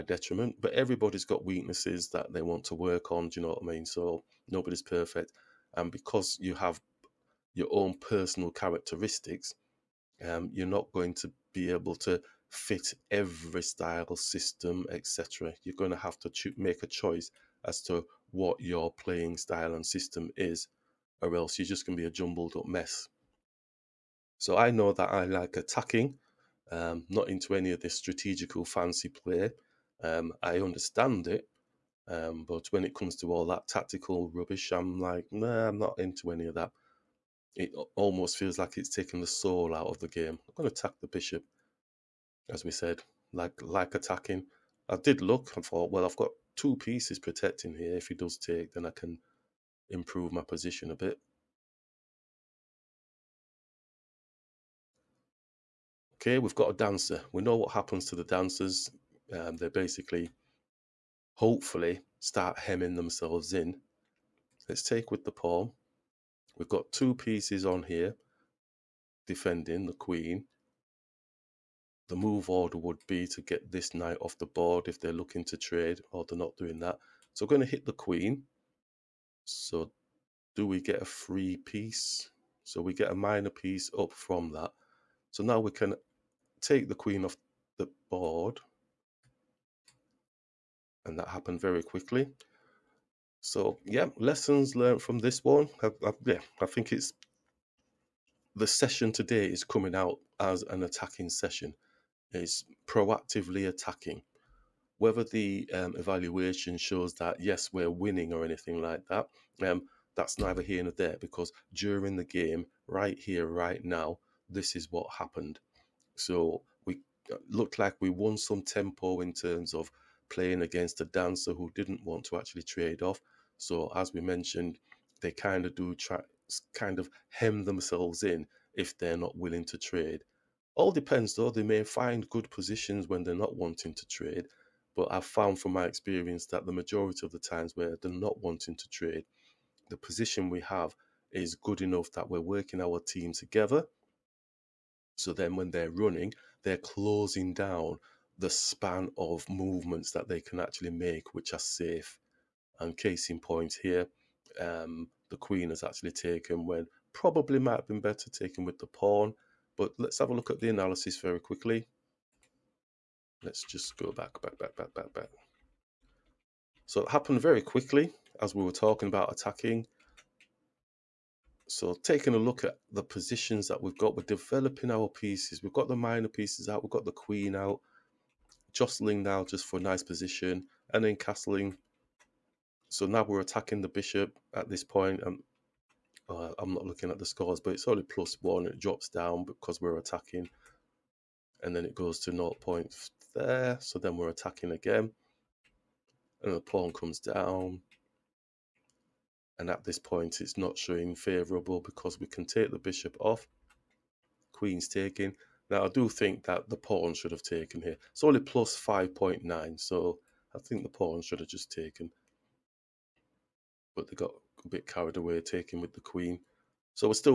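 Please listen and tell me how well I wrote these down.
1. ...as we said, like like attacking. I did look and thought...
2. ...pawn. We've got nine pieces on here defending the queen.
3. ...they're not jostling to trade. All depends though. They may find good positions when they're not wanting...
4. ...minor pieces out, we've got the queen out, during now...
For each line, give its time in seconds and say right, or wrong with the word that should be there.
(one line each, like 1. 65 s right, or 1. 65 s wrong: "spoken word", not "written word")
1. 42 s right
2. 65 s wrong: "two", not "nine"
3. 128 s wrong: "willing", not "jostling"
4. 175 s wrong: "jostling", not "during".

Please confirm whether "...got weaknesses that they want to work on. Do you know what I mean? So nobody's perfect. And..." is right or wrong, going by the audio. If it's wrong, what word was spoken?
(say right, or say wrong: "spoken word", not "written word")
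right.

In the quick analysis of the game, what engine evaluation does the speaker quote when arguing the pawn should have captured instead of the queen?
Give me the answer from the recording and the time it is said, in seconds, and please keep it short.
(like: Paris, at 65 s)
+5.9, at 208 s.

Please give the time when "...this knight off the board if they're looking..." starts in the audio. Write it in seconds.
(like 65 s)
73 s.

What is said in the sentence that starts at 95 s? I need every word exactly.
I, I, yeah, I think it's the session today is coming out as an attacking session.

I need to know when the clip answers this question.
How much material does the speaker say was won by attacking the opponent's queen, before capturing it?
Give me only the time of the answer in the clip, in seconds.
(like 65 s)
83 s.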